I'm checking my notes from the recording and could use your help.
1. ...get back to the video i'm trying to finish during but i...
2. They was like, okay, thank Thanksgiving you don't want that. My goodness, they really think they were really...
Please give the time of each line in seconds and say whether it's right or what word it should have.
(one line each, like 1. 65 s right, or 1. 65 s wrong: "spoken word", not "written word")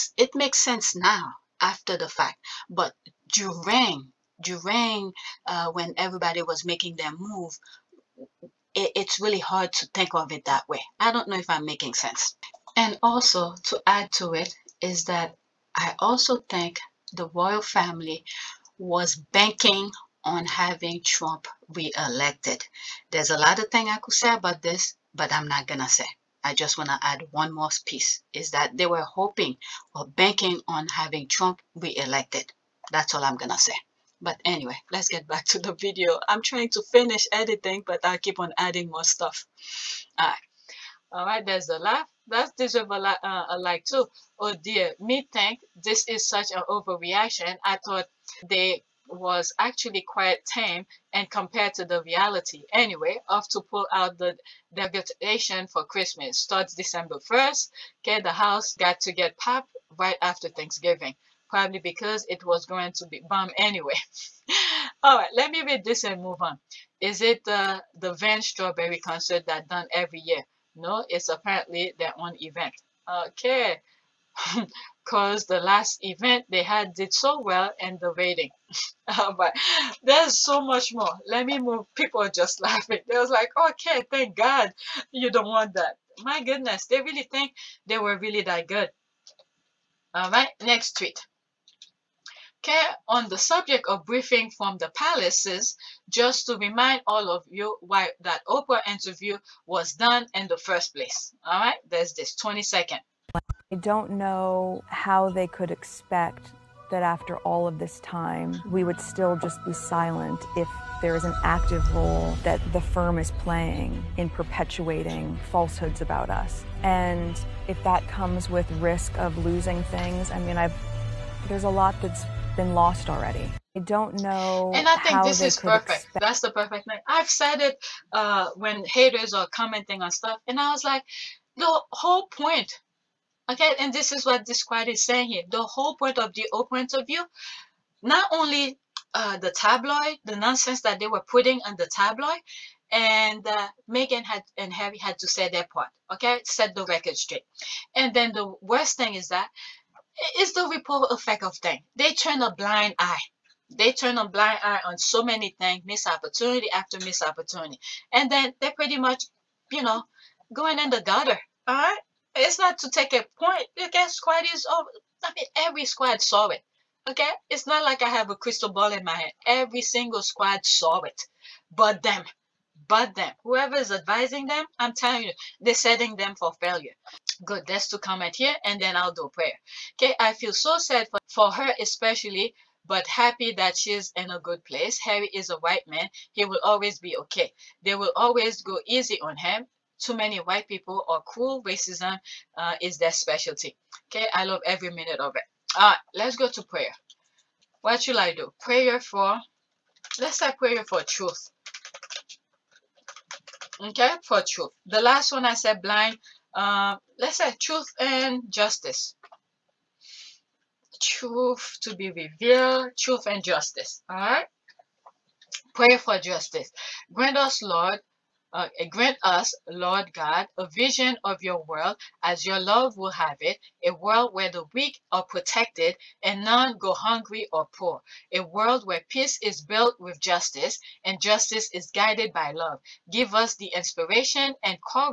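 1. 35 s wrong: "editing", not "during"
2. 83 s wrong: "God", not "Thanksgiving".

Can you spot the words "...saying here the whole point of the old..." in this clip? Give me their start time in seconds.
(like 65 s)
135 s.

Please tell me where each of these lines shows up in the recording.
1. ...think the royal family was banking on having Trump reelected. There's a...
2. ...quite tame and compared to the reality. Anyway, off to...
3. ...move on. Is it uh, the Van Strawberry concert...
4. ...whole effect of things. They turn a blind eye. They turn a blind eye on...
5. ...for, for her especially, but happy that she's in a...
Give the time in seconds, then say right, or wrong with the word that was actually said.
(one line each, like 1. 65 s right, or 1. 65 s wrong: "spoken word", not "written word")
1. 16 s right
2. 50 s right
3. 66 s right
4. 150 s wrong: "ripple", not "whole"
5. 181 s right.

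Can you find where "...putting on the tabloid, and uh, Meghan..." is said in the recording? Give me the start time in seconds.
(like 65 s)
141 s.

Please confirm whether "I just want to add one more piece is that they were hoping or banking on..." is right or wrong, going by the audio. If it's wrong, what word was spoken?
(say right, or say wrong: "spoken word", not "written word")
right.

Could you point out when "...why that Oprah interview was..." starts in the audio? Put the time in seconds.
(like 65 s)
97 s.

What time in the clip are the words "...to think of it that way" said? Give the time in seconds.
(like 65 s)
9 s.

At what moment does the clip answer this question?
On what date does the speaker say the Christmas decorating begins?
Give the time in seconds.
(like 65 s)
56 s.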